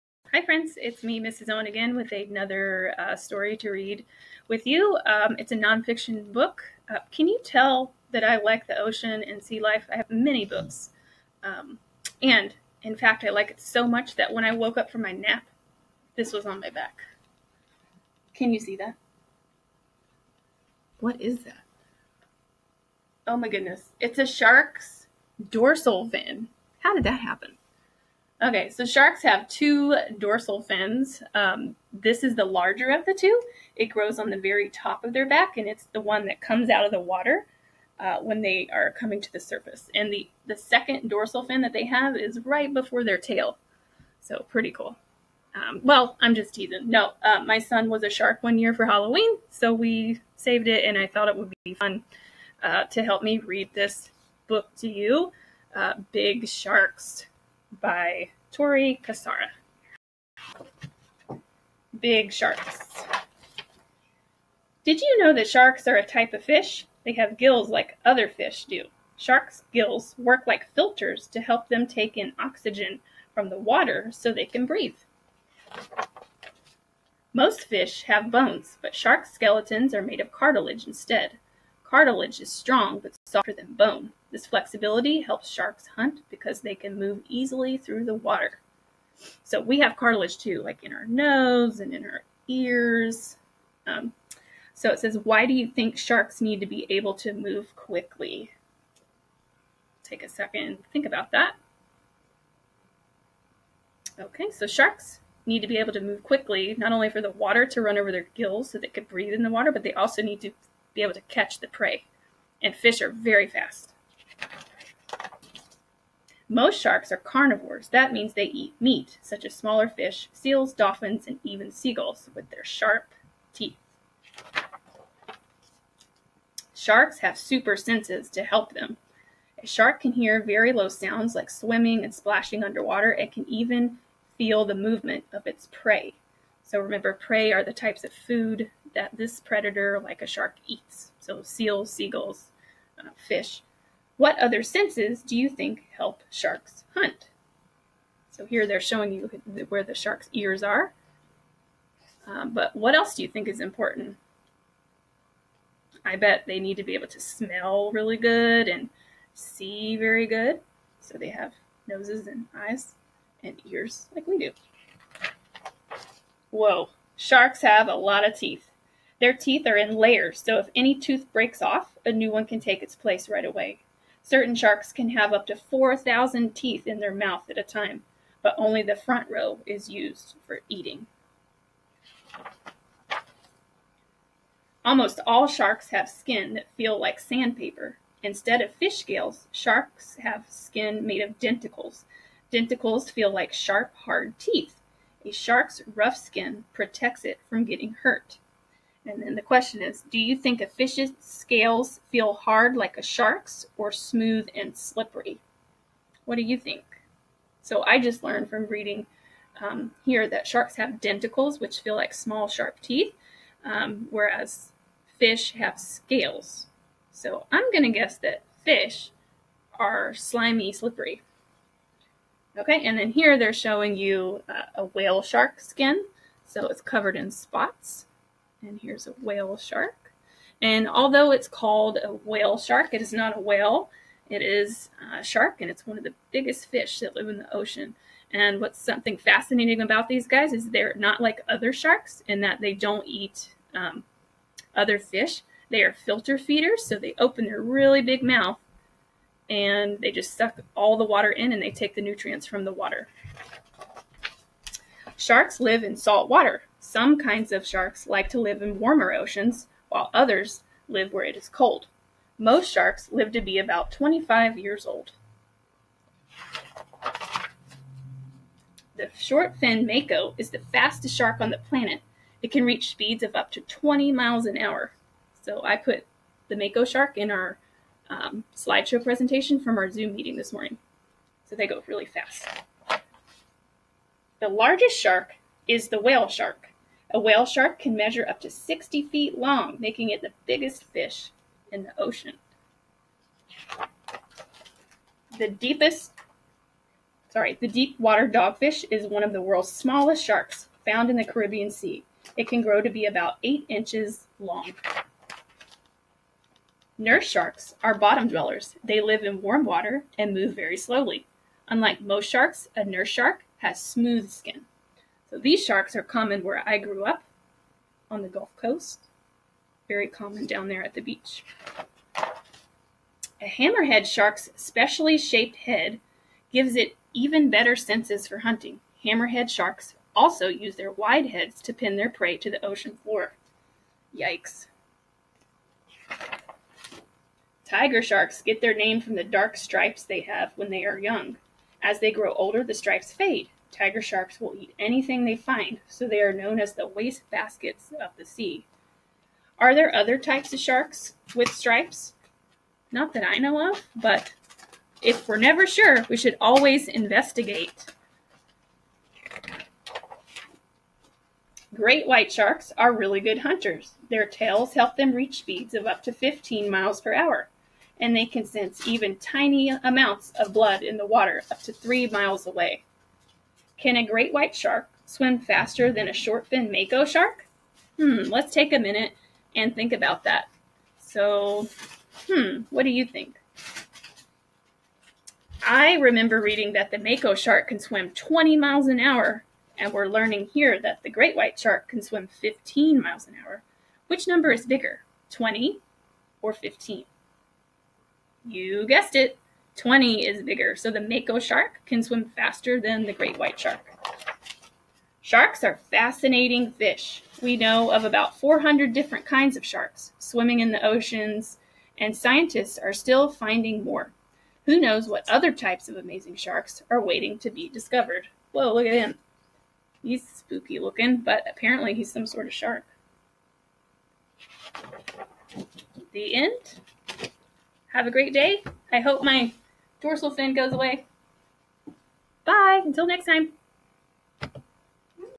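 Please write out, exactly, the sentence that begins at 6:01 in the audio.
Great white sharks are really good hunters.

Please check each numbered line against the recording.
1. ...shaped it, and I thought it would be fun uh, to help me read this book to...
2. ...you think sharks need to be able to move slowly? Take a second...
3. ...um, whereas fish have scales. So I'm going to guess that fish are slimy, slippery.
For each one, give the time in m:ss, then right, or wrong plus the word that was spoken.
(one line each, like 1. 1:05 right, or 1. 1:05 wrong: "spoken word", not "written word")
1. 0:50 wrong: "saved", not "shaped"
2. 1:35 wrong: "quickly", not "slowly"
3. 3:33 right.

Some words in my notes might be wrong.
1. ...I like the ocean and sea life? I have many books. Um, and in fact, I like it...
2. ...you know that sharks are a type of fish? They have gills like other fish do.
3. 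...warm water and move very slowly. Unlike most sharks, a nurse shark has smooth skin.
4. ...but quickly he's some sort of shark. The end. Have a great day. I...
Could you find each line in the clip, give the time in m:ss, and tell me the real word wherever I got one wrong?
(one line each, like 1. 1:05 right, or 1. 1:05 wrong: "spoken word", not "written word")
1. 0:08 right
2. 1:05 right
3. 5:09 right
4. 7:01 wrong: "apparently", not "quickly".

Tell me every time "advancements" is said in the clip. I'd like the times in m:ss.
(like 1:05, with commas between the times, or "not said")
not said.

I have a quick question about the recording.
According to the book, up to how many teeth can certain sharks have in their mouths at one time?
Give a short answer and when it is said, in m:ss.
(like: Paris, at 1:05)
4,000, at 2:55.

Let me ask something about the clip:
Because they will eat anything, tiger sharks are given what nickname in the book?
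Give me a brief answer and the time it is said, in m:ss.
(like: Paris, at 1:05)
waste baskets of the sea, at 5:46.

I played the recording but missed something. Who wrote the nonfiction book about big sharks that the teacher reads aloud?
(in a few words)
Tori Kosara.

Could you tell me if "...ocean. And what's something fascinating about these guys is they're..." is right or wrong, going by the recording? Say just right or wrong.
right.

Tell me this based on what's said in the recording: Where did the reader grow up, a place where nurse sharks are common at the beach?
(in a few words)
Gulf Coast.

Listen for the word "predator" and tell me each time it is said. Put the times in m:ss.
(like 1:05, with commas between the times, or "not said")
2:19.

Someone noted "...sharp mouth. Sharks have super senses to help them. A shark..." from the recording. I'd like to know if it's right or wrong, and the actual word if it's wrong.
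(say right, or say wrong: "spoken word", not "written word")
wrong: "teeth", not "mouth".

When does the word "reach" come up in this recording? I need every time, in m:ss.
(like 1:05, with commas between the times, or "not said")
4:32, 6:05.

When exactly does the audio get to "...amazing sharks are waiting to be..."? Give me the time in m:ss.
6:55.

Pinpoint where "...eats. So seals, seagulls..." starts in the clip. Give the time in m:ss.
2:20.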